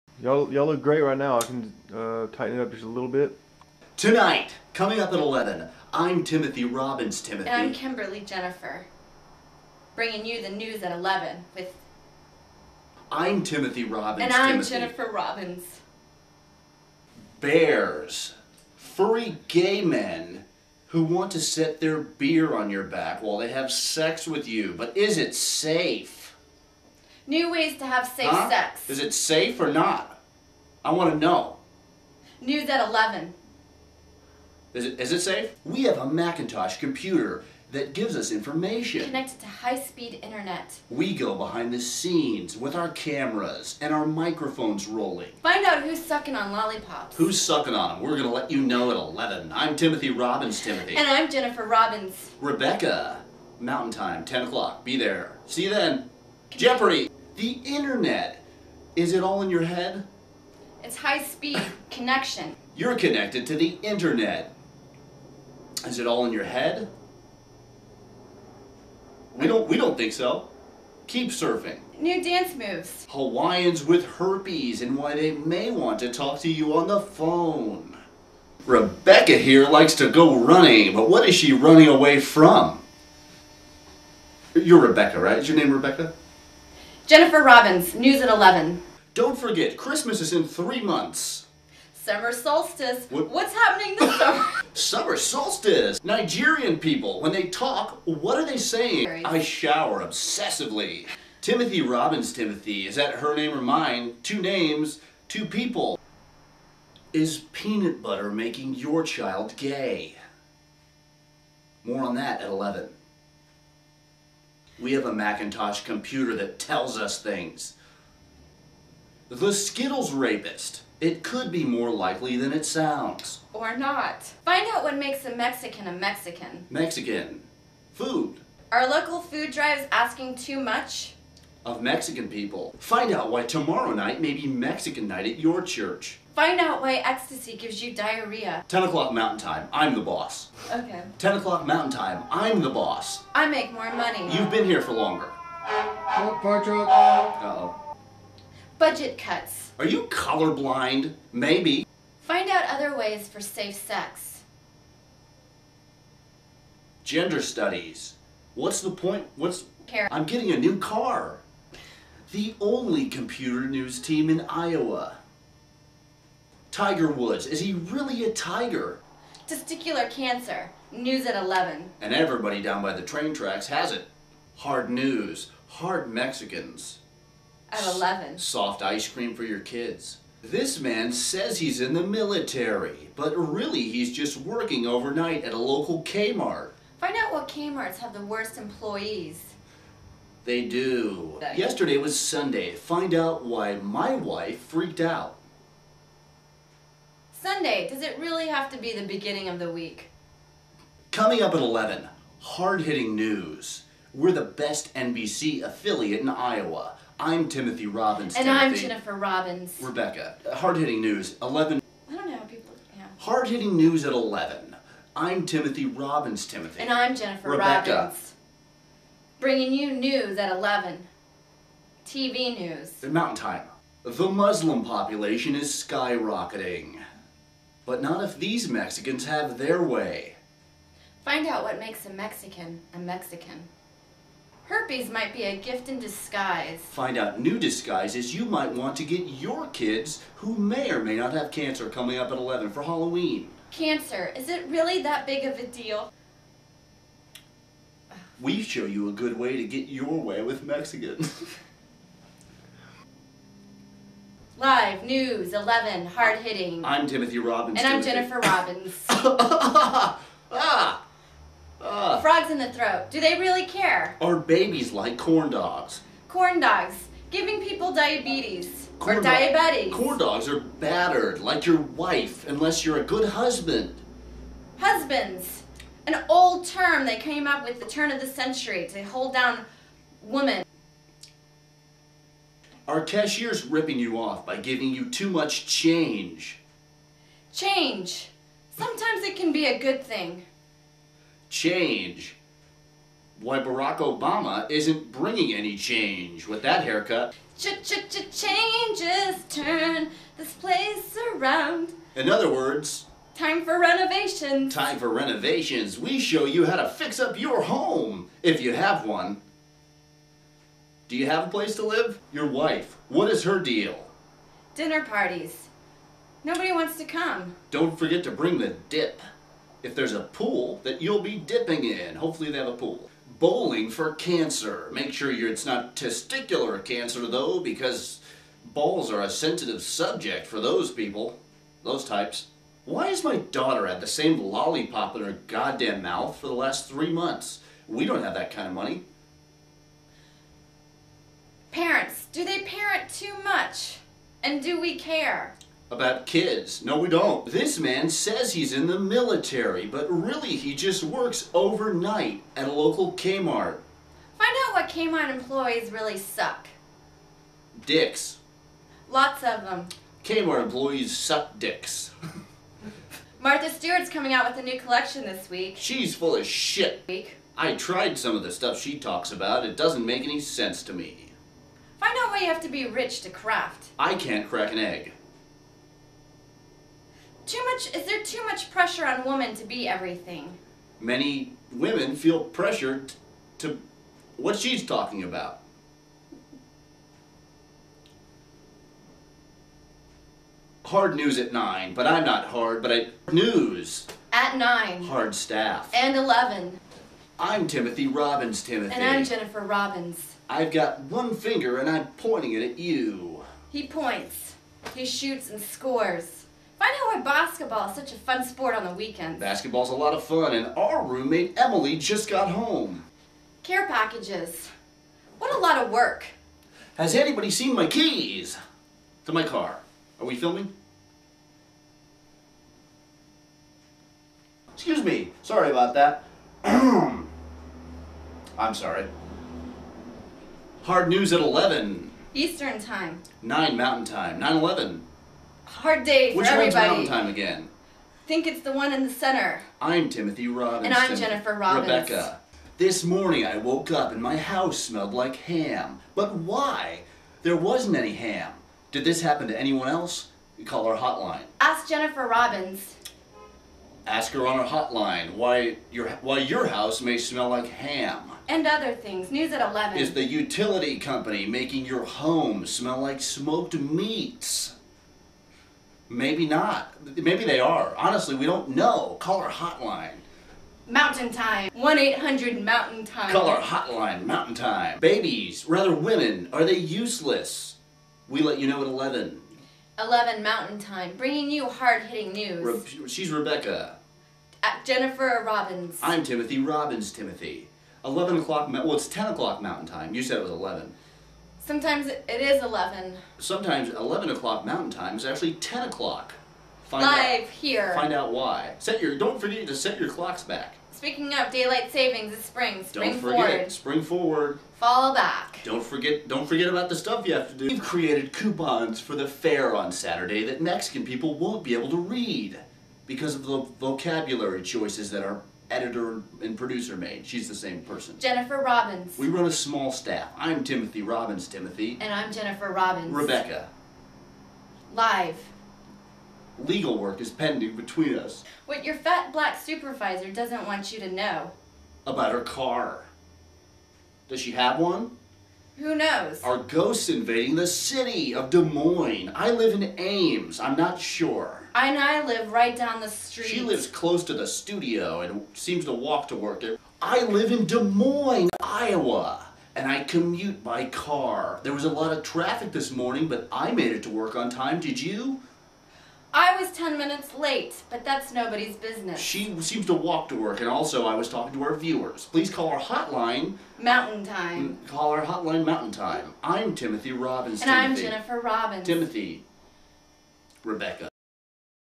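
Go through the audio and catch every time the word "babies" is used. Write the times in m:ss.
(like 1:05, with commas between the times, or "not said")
4:24, 7:54.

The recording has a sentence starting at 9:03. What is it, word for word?
She lives close to the studio and seems to walk to work.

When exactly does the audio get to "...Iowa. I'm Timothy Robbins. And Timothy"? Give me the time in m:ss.
3:26.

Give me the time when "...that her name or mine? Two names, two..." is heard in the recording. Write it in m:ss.
1:42.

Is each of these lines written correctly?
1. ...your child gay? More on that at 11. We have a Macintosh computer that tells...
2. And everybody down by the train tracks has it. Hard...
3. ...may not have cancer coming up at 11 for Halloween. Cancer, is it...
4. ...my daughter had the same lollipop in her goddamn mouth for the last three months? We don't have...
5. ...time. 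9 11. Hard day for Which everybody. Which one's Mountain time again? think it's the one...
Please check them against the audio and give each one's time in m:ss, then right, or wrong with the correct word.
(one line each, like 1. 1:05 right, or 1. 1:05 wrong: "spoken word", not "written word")
1. 1:48 right
2. 2:51 right
3. 4:01 right
4. 5:33 right
5. 7:14 right.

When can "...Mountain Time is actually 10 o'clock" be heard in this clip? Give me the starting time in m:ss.
8:14.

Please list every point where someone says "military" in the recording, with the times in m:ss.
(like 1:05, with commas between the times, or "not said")
3:02, 5:48.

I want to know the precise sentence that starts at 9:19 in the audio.
She seems to walk to work, and also I was talking to our viewers.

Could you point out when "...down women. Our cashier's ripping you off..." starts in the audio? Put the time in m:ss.
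4:39.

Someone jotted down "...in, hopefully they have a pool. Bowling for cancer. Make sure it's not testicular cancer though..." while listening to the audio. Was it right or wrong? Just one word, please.
right.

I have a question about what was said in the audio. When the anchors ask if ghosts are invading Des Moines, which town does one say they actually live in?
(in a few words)
Ames.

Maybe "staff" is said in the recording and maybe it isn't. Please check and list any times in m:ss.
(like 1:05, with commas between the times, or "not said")
6:35, 8:39.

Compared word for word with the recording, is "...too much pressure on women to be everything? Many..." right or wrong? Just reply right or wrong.
right.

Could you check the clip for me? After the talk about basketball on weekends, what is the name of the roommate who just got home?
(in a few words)
Emily.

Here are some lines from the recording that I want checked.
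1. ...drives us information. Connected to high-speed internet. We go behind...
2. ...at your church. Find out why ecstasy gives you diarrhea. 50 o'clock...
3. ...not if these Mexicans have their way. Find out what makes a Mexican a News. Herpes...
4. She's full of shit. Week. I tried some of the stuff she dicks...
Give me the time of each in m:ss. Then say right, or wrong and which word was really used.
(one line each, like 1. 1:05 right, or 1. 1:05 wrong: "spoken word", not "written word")
1. 0:37 wrong: "gives", not "drives"
2. 2:15 wrong: "10", not "50"
3. 3:48 wrong: "Mexican", not "News"
4. 6:05 wrong: "talks", not "dicks".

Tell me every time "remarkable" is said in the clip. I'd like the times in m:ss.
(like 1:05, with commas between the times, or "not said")
not said.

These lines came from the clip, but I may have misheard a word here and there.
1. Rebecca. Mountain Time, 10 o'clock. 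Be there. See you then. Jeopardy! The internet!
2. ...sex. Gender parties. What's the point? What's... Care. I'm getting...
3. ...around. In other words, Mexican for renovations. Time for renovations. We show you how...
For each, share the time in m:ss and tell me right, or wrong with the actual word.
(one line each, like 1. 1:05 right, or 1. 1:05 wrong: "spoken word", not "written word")
1. 0:52 right
2. 2:33 wrong: "studies", not "parties"
3. 5:01 wrong: "Time", not "Mexican".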